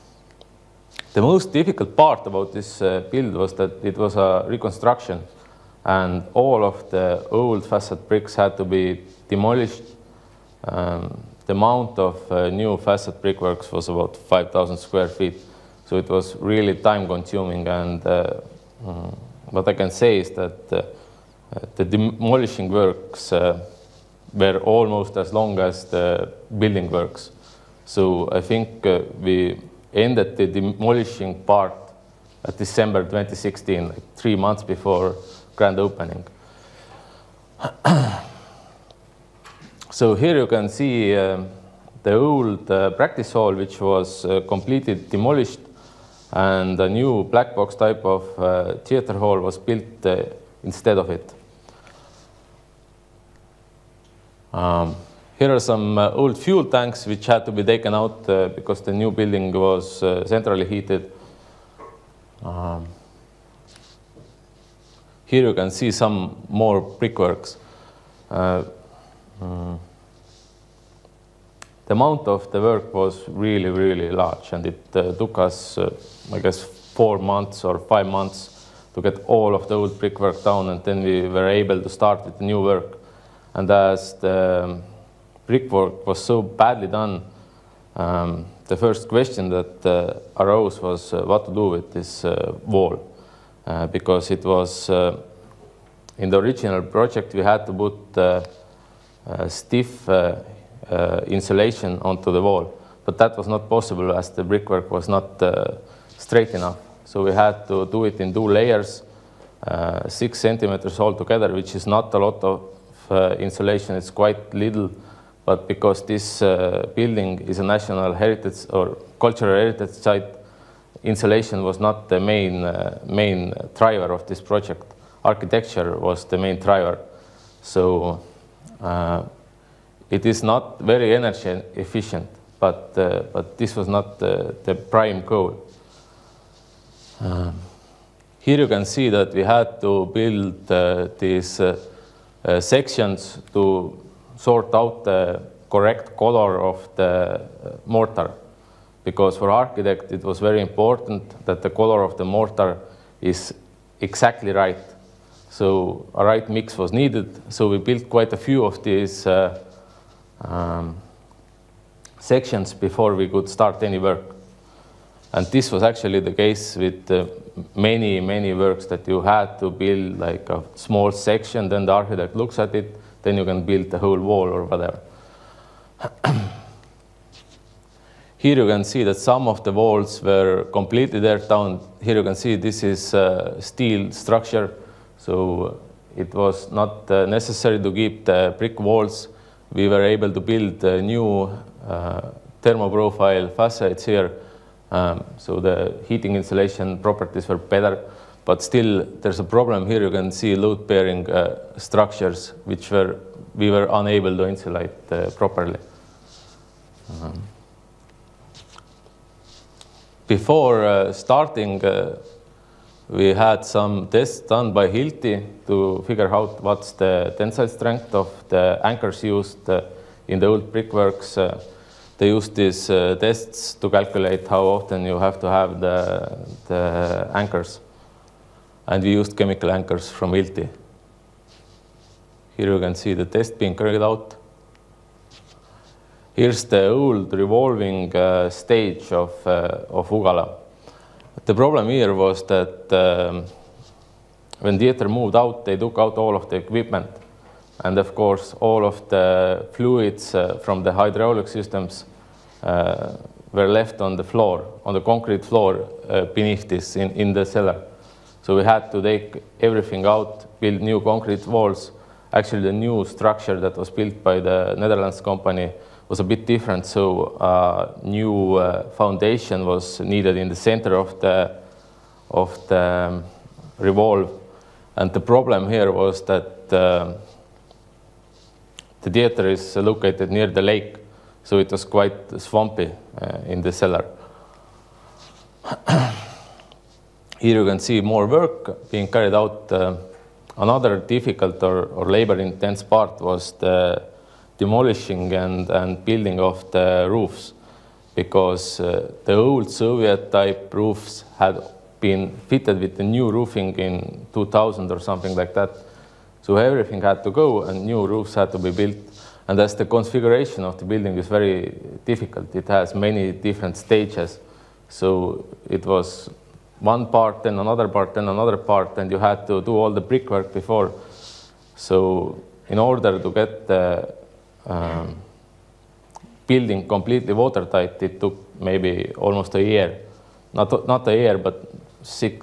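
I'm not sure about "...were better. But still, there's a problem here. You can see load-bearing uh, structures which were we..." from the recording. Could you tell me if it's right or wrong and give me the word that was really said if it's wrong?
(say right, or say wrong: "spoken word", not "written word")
right.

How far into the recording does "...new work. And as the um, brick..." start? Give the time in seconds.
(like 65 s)
82 s.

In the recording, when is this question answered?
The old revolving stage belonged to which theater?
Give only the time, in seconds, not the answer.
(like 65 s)
240 s.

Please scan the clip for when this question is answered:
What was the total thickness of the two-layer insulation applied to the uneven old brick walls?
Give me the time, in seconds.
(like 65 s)
110 s.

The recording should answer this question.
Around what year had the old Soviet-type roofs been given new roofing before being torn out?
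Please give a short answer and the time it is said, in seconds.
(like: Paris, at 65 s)
2000, at 304 s.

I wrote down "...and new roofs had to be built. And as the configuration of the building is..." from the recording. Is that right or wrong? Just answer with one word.
right.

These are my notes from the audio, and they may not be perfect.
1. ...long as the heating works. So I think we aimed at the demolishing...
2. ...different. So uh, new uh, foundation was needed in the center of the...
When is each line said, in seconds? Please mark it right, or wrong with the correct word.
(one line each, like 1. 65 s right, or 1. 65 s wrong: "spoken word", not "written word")
1. 25 s wrong: "building", not "heating"
2. 266 s right.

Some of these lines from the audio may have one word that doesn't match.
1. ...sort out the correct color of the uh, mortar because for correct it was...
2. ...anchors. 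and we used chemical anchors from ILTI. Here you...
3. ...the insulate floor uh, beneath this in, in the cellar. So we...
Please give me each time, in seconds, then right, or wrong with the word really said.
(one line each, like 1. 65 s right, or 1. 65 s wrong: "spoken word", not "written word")
1. 144 s wrong: "architect", not "correct"
2. 227 s right
3. 254 s wrong: "concrete", not "insulate".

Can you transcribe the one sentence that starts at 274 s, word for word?
And the problem here was that uh, the theater is located near the lake.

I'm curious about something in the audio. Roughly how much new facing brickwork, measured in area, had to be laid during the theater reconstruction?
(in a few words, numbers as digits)
5,000 square feet.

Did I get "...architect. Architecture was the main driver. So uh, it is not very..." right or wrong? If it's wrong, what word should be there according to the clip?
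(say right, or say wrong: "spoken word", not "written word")
wrong: "project", not "architect".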